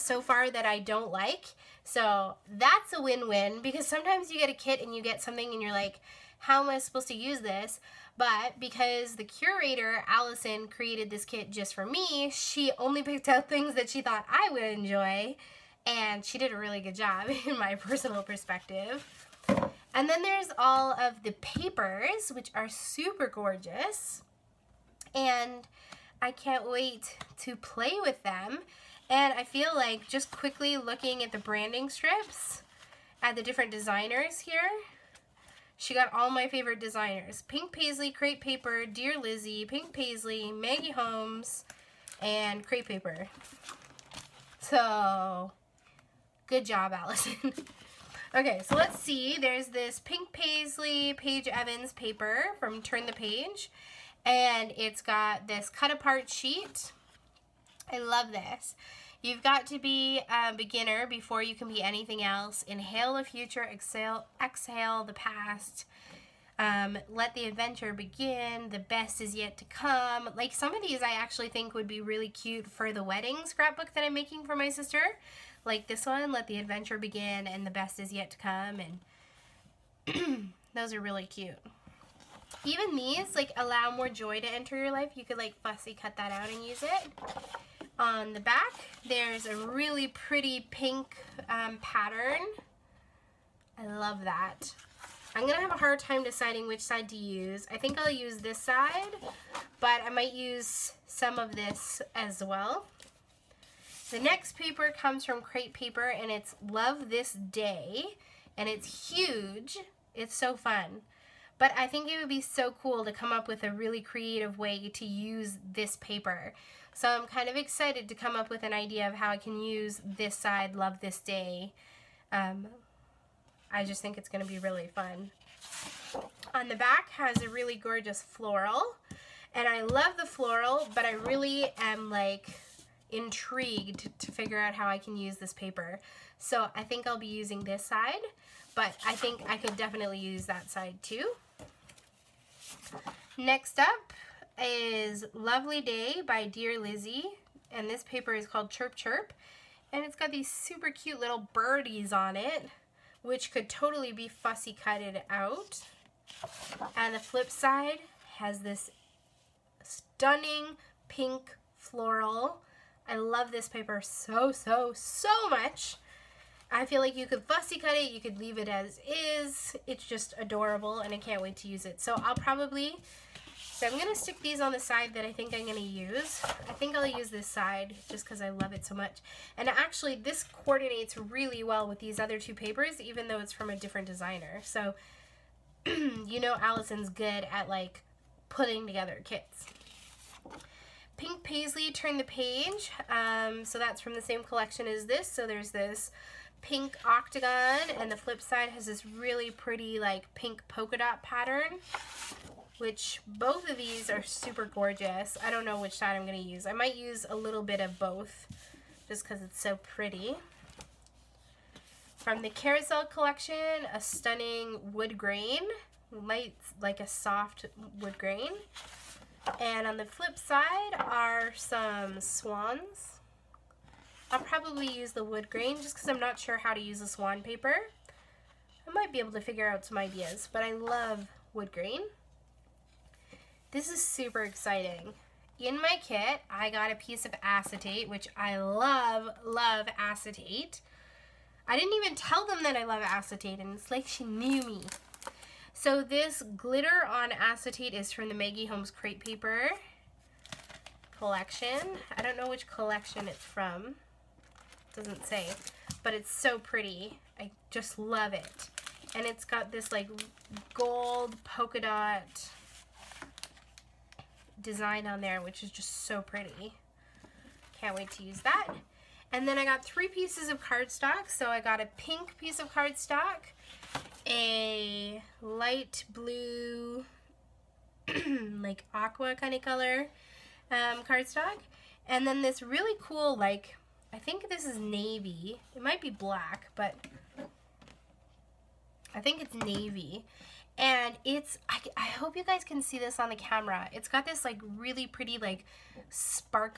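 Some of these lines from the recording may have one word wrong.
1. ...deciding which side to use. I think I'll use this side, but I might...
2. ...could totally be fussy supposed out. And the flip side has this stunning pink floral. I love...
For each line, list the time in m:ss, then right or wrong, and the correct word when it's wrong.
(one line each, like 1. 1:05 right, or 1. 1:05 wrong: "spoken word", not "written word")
1. 1:36 right
2. 2:33 wrong: "cutted", not "supposed".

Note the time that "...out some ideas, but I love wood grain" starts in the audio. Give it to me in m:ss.
3:49.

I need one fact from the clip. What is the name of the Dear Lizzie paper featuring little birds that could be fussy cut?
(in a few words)
Chirp Chirp.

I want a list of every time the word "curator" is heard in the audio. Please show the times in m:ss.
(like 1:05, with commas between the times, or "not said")
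0:09.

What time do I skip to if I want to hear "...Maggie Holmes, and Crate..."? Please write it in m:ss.
0:40.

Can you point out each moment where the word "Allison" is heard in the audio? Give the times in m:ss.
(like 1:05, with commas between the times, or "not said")
0:10, 0:46, 3:06.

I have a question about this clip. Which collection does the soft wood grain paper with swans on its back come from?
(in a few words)
Carousel Collection.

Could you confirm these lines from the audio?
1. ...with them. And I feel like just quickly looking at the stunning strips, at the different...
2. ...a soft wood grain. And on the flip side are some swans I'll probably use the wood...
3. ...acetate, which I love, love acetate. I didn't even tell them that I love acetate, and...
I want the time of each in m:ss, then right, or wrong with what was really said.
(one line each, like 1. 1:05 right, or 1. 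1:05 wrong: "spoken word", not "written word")
1. 0:28 wrong: "branding", not "stunning"
2. 3:37 right
3. 3:57 right.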